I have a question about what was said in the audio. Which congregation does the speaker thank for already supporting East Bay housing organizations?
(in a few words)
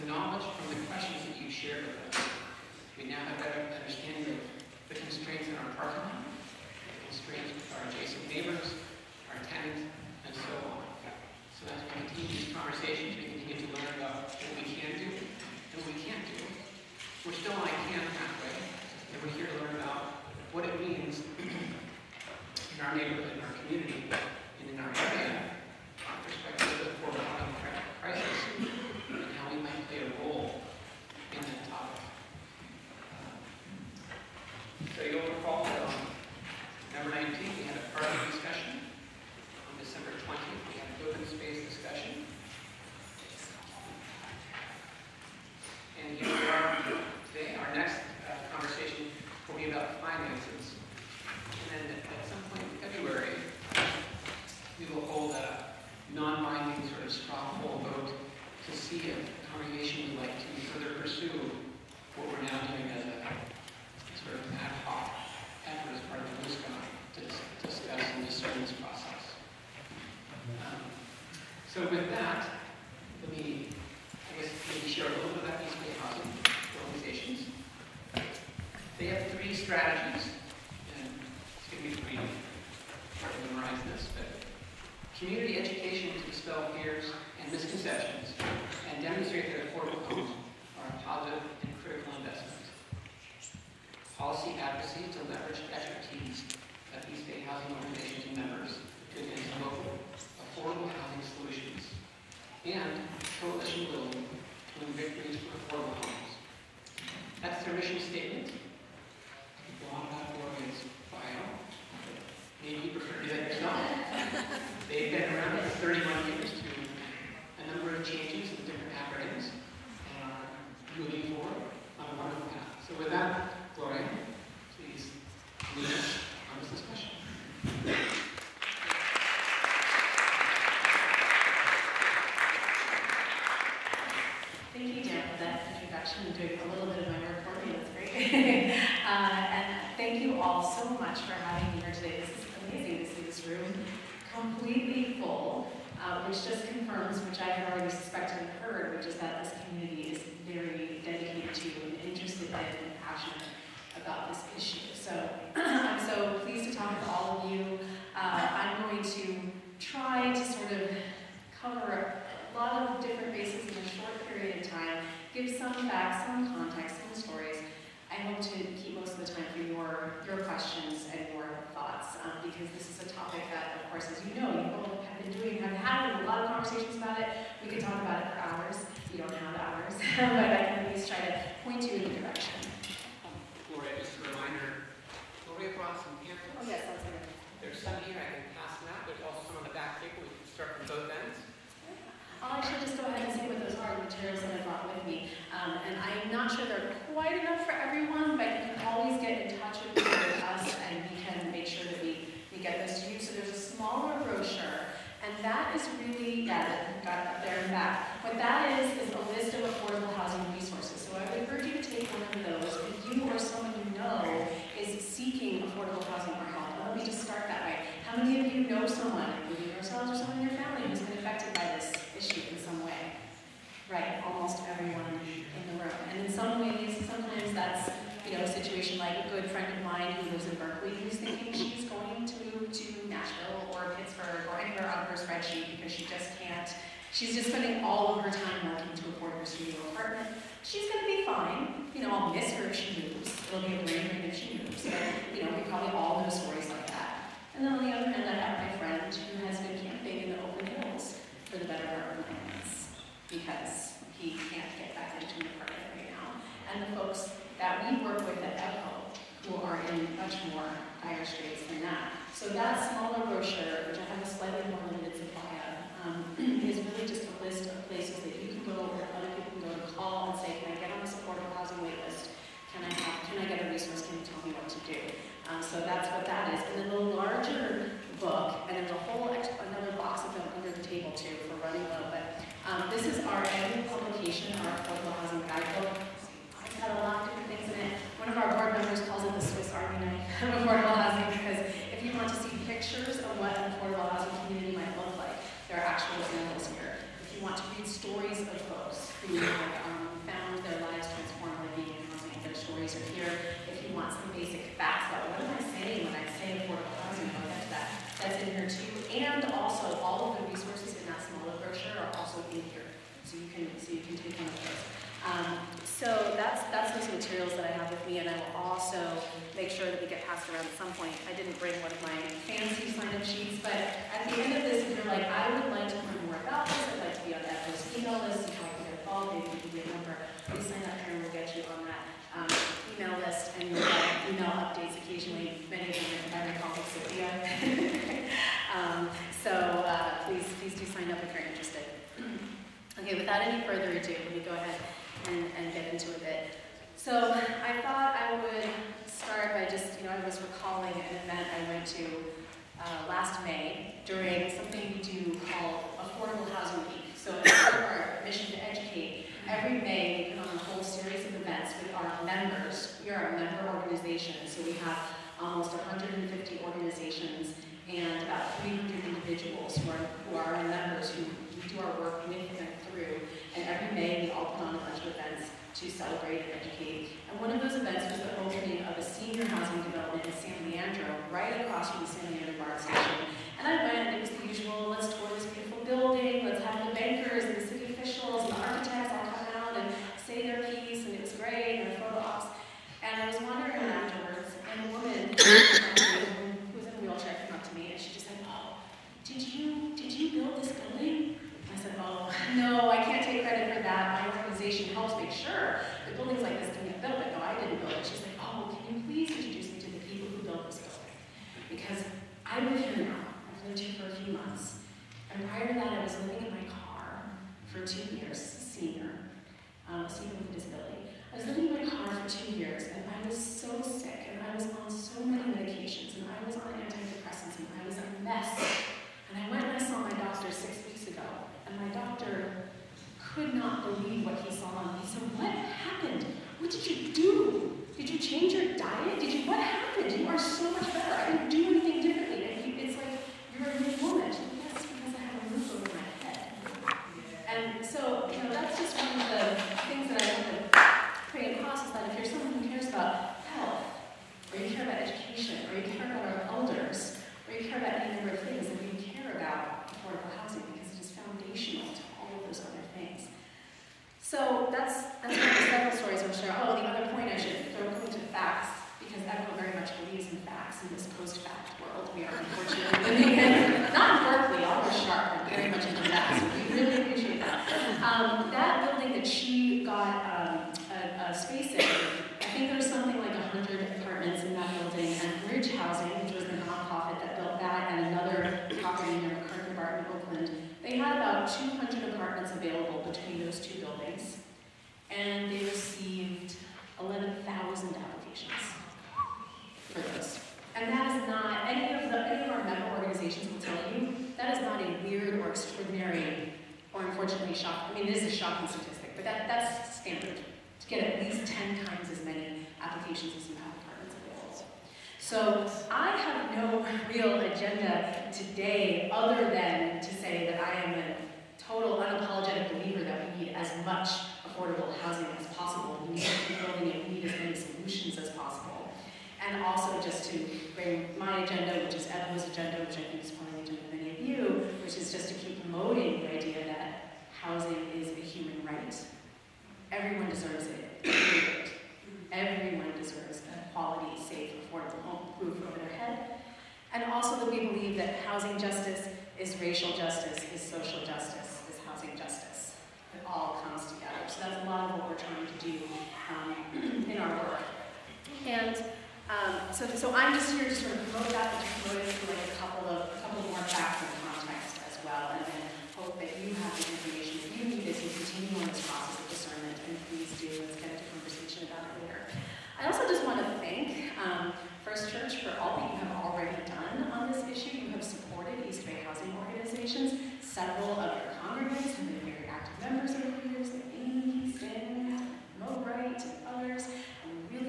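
First Church.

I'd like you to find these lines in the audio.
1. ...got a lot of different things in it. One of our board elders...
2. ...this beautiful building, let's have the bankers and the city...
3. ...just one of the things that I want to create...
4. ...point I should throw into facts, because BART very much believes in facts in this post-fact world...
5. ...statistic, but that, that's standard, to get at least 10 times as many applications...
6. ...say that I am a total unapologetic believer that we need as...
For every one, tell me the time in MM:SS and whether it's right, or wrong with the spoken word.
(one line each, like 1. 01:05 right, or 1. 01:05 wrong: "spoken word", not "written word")
1. 04:46 wrong: "members", not "elders"
2. 06:25 right
3. 07:28 right
4. 07:47 wrong: "EBHO", not "BART"
5. 08:28 right
6. 08:40 right.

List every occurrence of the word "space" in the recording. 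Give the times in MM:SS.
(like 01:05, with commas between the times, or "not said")
08:01.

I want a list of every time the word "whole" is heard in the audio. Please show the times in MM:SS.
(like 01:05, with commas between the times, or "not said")
04:39, 06:00.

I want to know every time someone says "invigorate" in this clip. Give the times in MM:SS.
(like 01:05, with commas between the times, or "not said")
01:44.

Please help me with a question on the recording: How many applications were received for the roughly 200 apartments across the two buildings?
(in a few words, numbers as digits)
11,000.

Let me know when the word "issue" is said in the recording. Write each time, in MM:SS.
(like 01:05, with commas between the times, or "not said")
09:37.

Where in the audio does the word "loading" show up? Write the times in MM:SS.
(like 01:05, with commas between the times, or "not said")
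not said.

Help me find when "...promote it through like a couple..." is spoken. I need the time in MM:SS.
09:21.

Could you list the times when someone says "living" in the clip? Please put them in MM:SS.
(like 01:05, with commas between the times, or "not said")
06:56, 07:01, 07:53.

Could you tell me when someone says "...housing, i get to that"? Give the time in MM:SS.
05:06.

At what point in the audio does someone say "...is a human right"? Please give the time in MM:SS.
08:57.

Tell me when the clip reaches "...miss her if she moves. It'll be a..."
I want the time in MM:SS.
04:02.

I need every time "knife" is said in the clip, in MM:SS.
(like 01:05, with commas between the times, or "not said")
04:50.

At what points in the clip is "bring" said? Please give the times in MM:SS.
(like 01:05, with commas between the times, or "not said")
05:21, 08:50.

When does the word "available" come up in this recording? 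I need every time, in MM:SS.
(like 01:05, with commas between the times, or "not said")
08:12, 08:34.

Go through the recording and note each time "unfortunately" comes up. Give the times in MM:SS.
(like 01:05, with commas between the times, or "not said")
07:52, 08:27.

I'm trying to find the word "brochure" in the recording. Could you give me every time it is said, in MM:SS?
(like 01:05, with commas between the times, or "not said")
04:23, 05:11.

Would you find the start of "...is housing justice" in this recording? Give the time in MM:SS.
09:11.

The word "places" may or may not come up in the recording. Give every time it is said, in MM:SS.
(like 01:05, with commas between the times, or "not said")
04:27.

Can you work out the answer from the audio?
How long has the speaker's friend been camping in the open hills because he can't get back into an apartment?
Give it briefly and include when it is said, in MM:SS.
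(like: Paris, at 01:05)
9 months, at 04:12.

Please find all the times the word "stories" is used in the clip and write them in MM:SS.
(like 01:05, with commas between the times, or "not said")
04:06, 04:57, 05:02, 07:45.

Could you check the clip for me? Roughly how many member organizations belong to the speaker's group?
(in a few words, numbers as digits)
150.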